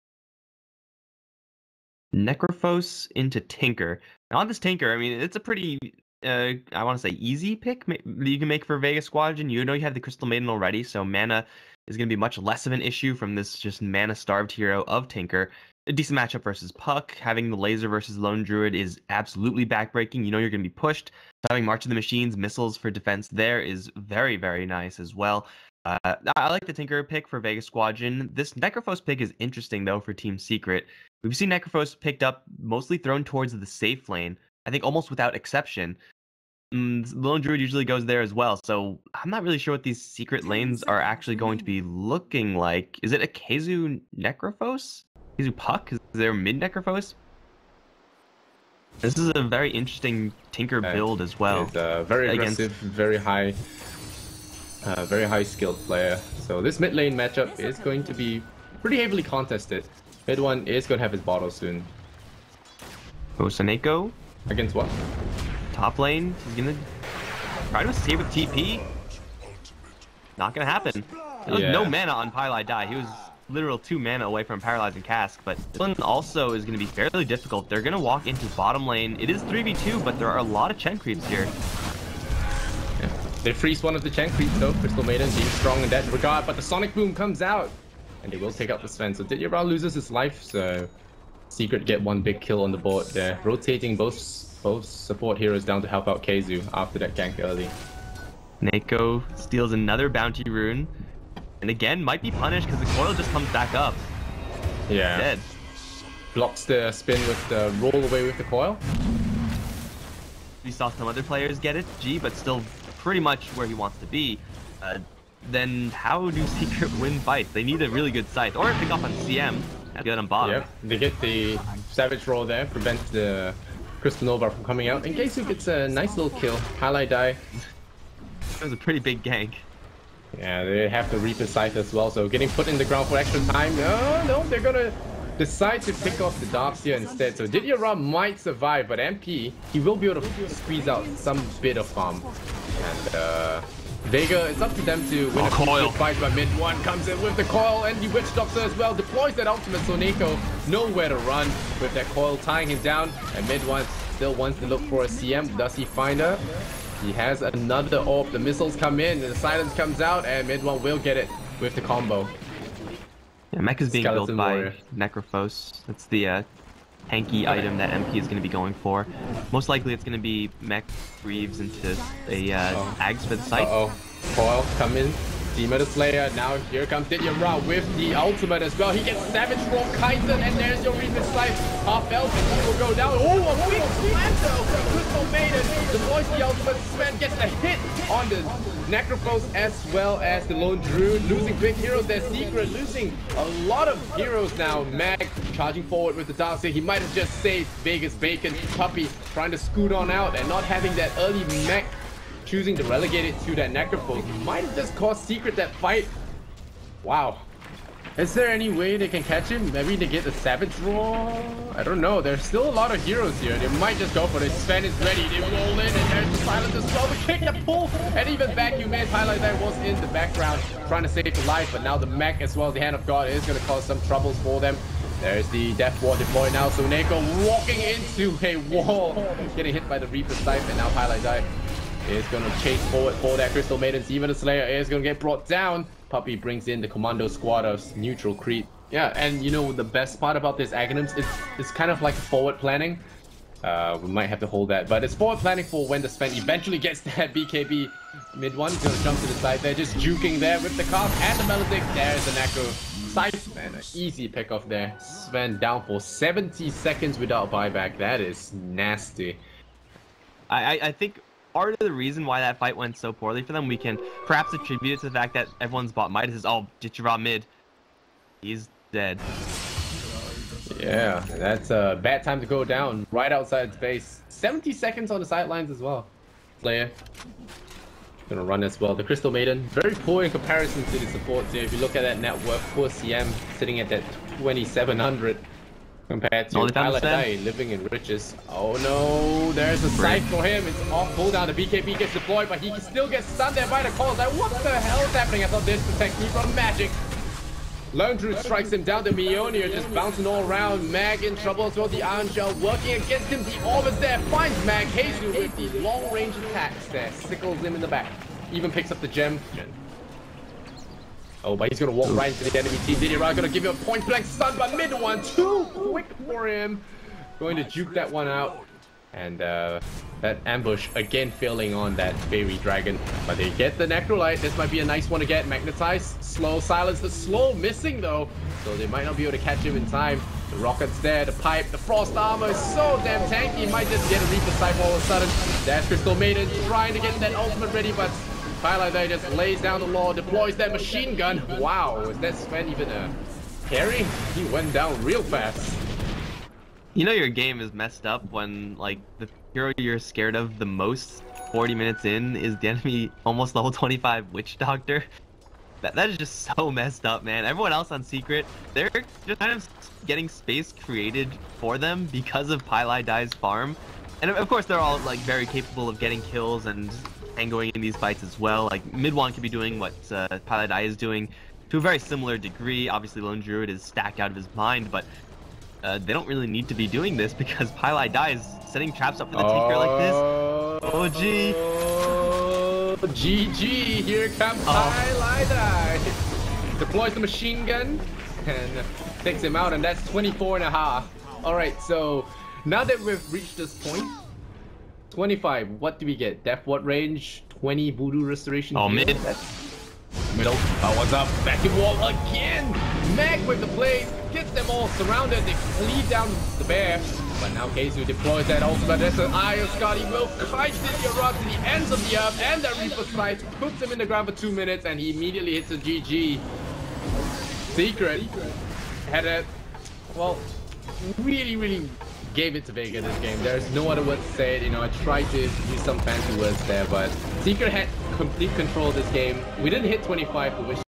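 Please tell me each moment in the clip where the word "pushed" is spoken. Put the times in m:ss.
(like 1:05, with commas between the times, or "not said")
0:20.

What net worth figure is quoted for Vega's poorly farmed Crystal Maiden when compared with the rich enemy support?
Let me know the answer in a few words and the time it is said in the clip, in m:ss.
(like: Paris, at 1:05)
2700, at 4:44.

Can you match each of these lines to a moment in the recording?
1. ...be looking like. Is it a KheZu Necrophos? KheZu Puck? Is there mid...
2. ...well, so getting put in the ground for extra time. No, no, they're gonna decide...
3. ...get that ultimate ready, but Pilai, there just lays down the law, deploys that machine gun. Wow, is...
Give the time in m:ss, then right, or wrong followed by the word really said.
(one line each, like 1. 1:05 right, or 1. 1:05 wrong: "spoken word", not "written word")
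1. 0:41 right
2. 2:11 right
3. 5:36 right.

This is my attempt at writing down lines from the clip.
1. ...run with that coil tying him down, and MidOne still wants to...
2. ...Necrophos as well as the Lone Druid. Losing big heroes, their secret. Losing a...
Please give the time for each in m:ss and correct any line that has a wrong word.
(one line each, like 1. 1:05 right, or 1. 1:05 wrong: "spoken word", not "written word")
1. 2:31 right
2. 3:08 right.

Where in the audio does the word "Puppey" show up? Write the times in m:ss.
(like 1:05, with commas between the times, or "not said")
3:18, 3:56.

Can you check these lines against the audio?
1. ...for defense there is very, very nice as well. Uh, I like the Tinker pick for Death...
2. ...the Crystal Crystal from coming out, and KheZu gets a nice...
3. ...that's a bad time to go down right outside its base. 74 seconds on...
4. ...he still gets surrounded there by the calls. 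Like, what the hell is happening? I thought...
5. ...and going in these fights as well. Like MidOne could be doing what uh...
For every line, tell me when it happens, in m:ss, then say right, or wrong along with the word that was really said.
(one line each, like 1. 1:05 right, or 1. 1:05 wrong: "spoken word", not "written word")
1. 0:22 wrong: "Vegas", not "Death"
2. 2:03 wrong: "Nova", not "Crystal"
3. 4:31 wrong: "70", not "74"
4. 4:52 wrong: "stunned", not "surrounded"
5. 6:07 right.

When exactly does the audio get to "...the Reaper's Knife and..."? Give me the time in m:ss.
3:49.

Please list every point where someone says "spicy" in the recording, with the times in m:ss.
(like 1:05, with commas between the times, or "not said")
not said.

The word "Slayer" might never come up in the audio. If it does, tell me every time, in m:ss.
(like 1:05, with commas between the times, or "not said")
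2:55, 3:54.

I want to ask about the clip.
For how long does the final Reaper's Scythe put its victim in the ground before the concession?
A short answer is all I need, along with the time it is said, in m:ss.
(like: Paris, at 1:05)
2 minutes, at 6:54.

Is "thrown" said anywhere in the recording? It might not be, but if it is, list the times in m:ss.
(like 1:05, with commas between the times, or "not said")
0:32.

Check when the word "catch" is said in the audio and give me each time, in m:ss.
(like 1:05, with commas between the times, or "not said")
3:29, 5:29.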